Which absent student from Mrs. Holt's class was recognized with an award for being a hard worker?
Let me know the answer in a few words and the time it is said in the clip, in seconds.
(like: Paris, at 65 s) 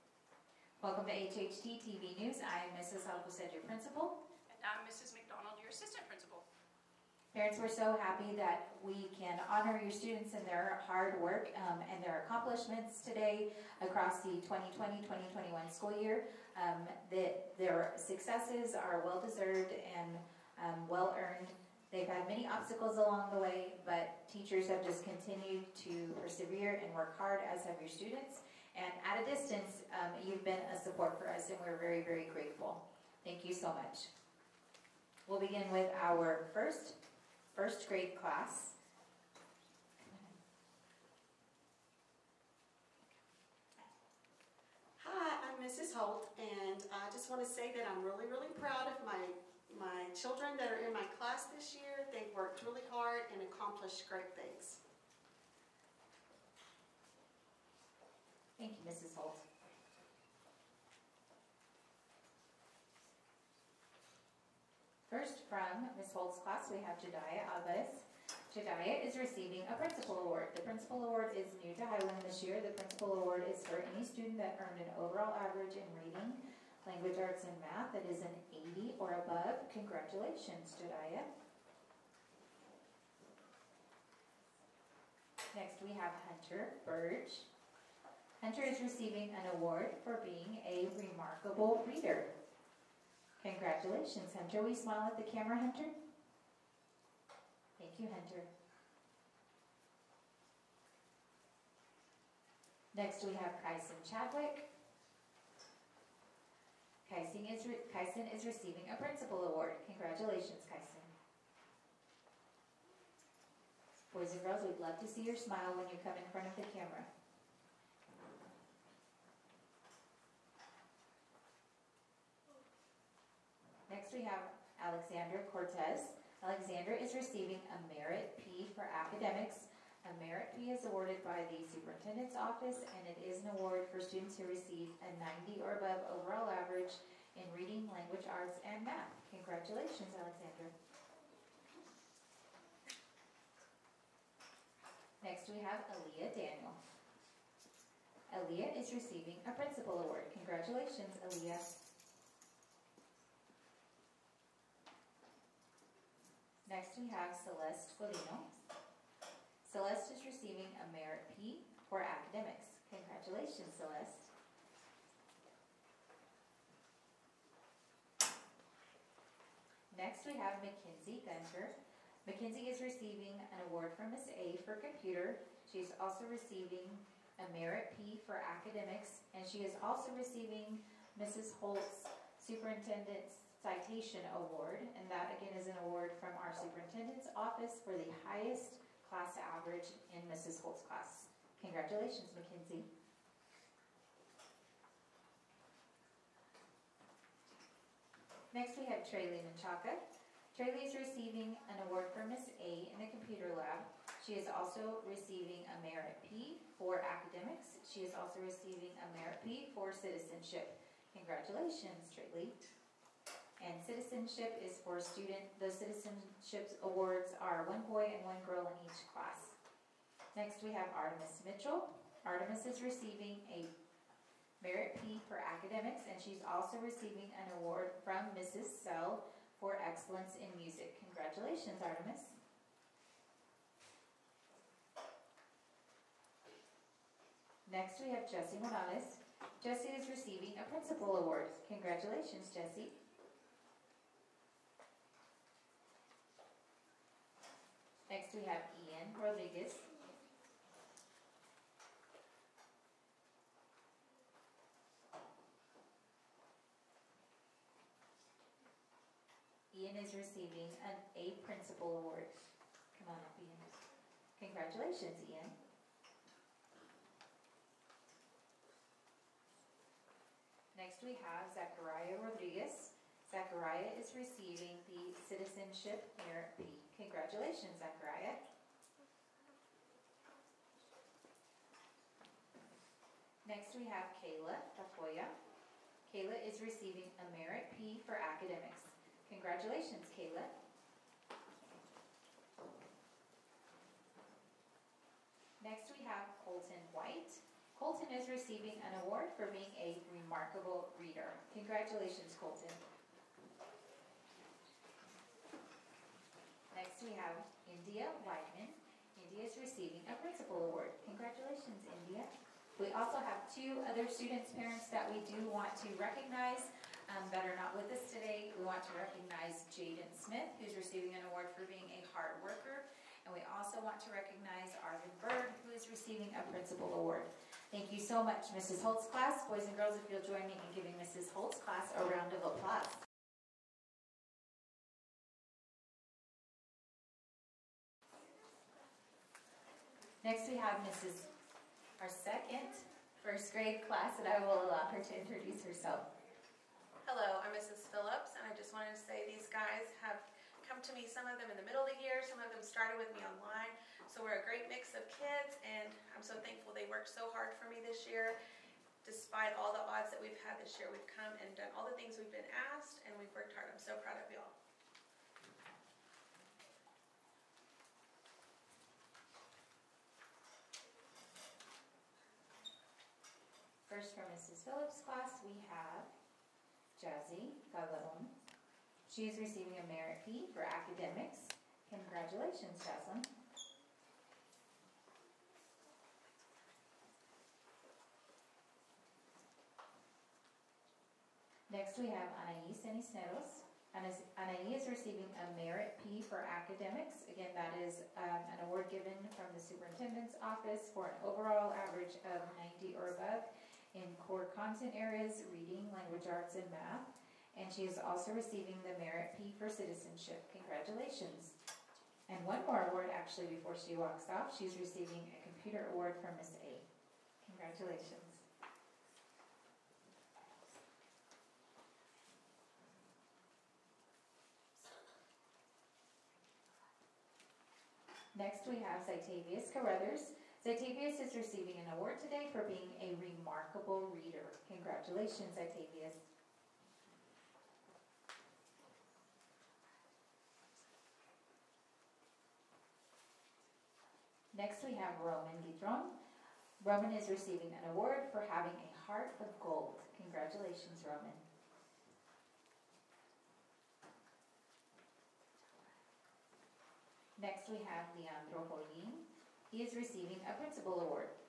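Jaden Smith, at 319 s.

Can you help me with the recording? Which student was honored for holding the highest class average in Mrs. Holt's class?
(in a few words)
Mackenzie Gunter.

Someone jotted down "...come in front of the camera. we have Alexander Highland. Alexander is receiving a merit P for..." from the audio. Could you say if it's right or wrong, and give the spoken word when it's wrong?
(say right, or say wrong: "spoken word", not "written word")
wrong: "Cortez", not "Highland".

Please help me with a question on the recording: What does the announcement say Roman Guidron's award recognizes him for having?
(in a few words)
a heart of gold.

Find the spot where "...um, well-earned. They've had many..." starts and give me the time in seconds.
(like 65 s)
20 s.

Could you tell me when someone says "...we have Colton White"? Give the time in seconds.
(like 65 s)
295 s.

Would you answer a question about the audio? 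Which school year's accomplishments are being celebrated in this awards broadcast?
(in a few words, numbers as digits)
2020-2021.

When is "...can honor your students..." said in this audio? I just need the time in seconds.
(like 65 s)
9 s.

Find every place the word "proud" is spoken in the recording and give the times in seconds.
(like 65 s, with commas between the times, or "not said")
48 s, 363 s.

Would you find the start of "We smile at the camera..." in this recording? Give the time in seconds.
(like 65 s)
94 s.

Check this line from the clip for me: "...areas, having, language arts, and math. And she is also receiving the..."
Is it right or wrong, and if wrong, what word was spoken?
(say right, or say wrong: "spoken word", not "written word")
wrong: "reading", not "having".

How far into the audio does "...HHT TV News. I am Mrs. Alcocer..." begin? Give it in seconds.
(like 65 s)
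1 s.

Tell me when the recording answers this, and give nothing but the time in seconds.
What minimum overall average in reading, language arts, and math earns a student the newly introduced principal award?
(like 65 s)
78 s.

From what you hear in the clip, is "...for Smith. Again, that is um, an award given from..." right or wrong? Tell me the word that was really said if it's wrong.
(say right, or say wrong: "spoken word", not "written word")
wrong: "Academics", not "Smith".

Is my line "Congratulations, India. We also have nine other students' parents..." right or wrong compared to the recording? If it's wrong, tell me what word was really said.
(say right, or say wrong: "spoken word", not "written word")
wrong: "two", not "nine".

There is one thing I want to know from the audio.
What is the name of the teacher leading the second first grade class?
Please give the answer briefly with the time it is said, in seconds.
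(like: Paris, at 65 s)
Mrs. Phillips, at 347 s.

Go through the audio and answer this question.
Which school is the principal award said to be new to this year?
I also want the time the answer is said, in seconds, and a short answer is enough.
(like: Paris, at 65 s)
Highland, at 71 s.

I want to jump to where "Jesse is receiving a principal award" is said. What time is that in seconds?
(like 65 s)
239 s.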